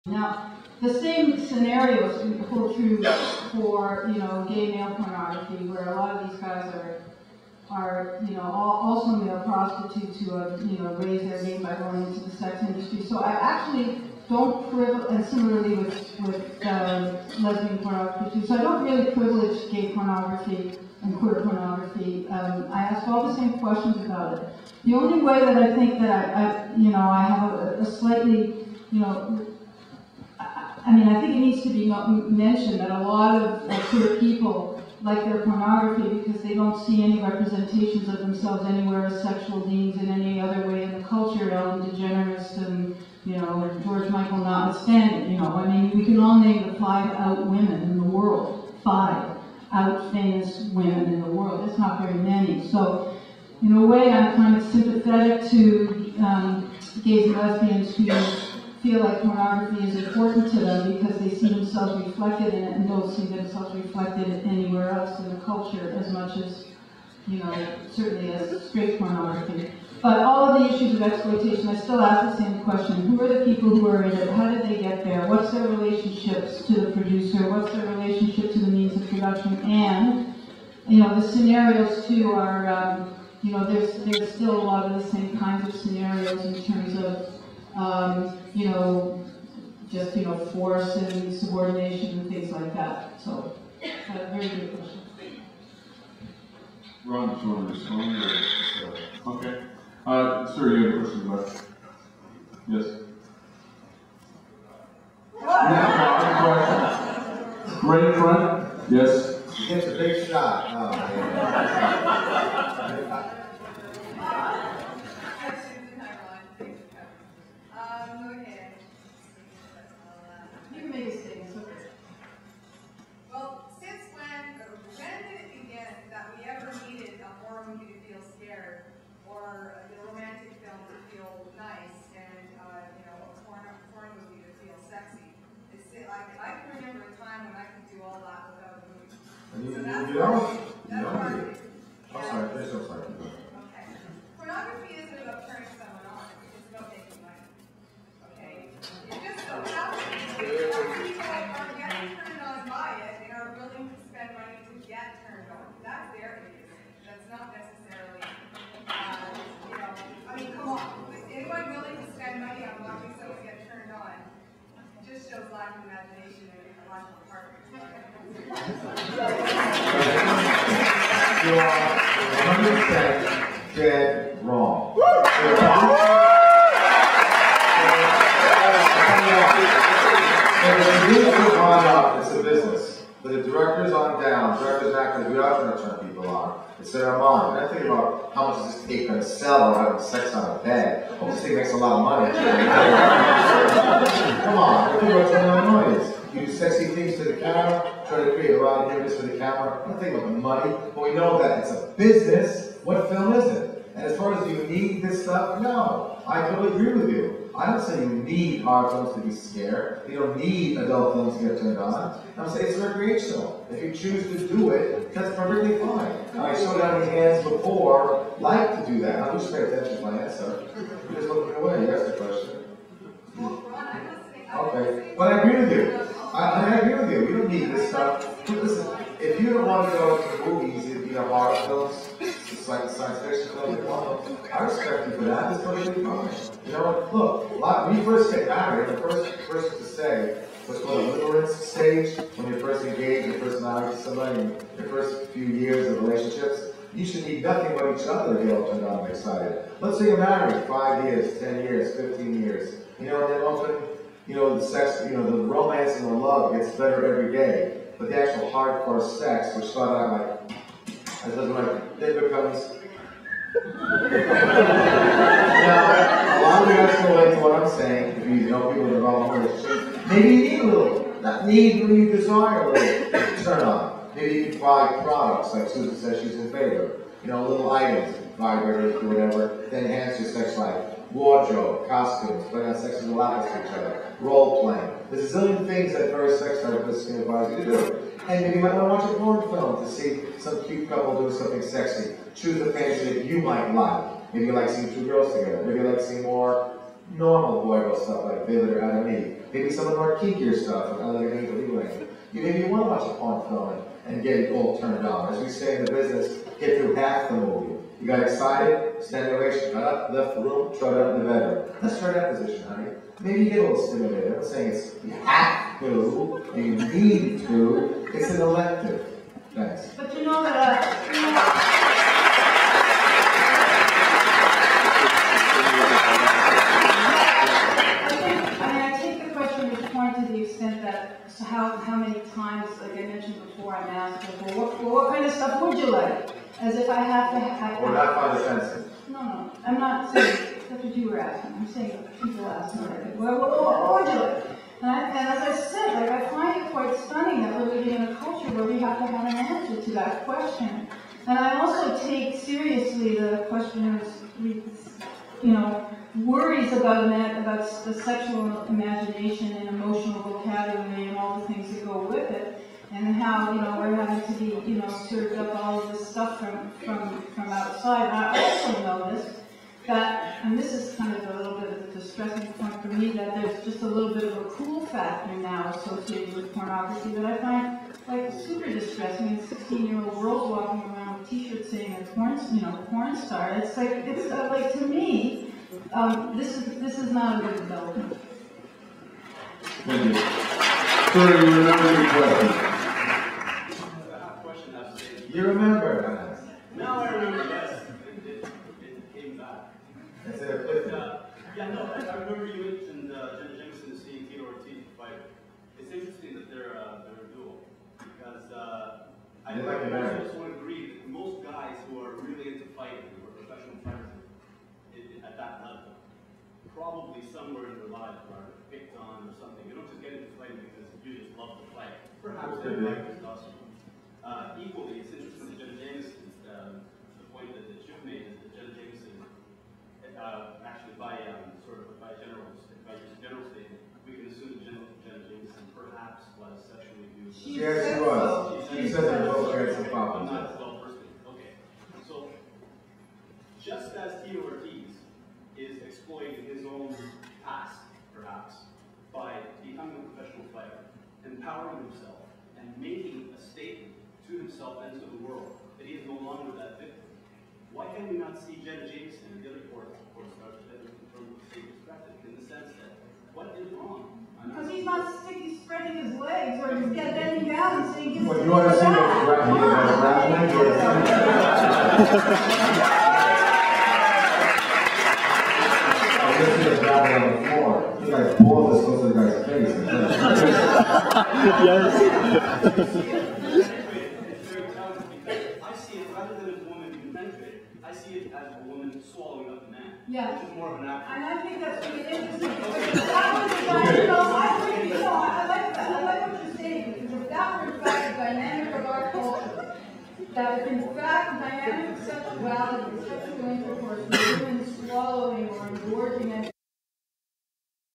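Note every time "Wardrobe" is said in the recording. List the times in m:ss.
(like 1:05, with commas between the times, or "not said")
4:41.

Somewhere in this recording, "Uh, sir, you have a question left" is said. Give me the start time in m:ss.
1:40.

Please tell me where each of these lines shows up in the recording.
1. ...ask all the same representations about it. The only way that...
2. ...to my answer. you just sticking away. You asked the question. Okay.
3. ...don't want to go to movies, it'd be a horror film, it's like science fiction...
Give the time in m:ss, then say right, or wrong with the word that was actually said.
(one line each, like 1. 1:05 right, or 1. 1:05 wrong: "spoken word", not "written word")
1. 0:22 wrong: "questions", not "representations"
2. 3:39 wrong: "looking", not "sticking"
3. 3:49 right.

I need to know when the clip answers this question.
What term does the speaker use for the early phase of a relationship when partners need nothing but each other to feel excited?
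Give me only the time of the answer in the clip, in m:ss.
4:01.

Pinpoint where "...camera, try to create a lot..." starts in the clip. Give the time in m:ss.
3:17.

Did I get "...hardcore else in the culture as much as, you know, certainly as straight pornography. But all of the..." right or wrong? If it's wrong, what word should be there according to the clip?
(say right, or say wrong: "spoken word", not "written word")
wrong: "anywhere", not "hardcore".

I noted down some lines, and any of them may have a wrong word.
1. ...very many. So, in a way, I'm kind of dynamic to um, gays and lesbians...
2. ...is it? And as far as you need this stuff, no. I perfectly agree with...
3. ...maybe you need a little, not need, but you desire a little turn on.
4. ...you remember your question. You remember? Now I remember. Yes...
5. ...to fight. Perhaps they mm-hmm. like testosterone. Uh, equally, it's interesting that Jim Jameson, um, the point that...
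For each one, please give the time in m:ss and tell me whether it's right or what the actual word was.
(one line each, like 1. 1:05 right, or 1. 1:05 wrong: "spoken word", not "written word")
1. 0:52 wrong: "sympathetic", not "dynamic"
2. 3:23 wrong: "totally", not "perfectly"
3. 4:30 right
4. 6:31 right
5. 7:01 right.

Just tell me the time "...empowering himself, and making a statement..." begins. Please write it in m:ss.
7:31.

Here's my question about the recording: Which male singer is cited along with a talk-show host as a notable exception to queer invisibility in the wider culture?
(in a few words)
George Michael.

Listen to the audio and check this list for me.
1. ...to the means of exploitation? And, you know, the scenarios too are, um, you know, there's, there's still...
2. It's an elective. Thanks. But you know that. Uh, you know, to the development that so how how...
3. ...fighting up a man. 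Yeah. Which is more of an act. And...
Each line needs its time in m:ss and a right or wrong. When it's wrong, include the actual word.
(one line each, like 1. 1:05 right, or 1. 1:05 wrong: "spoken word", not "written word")
1. 1:18 wrong: "production", not "exploitation"
2. 5:18 wrong: "extent", not "development"
3. 8:09 wrong: "swallowing", not "fighting".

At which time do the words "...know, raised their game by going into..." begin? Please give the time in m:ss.
0:10.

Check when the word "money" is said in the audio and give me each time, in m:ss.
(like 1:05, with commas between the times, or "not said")
3:12, 3:20.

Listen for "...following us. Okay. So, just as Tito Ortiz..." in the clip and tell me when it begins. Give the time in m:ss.
7:19.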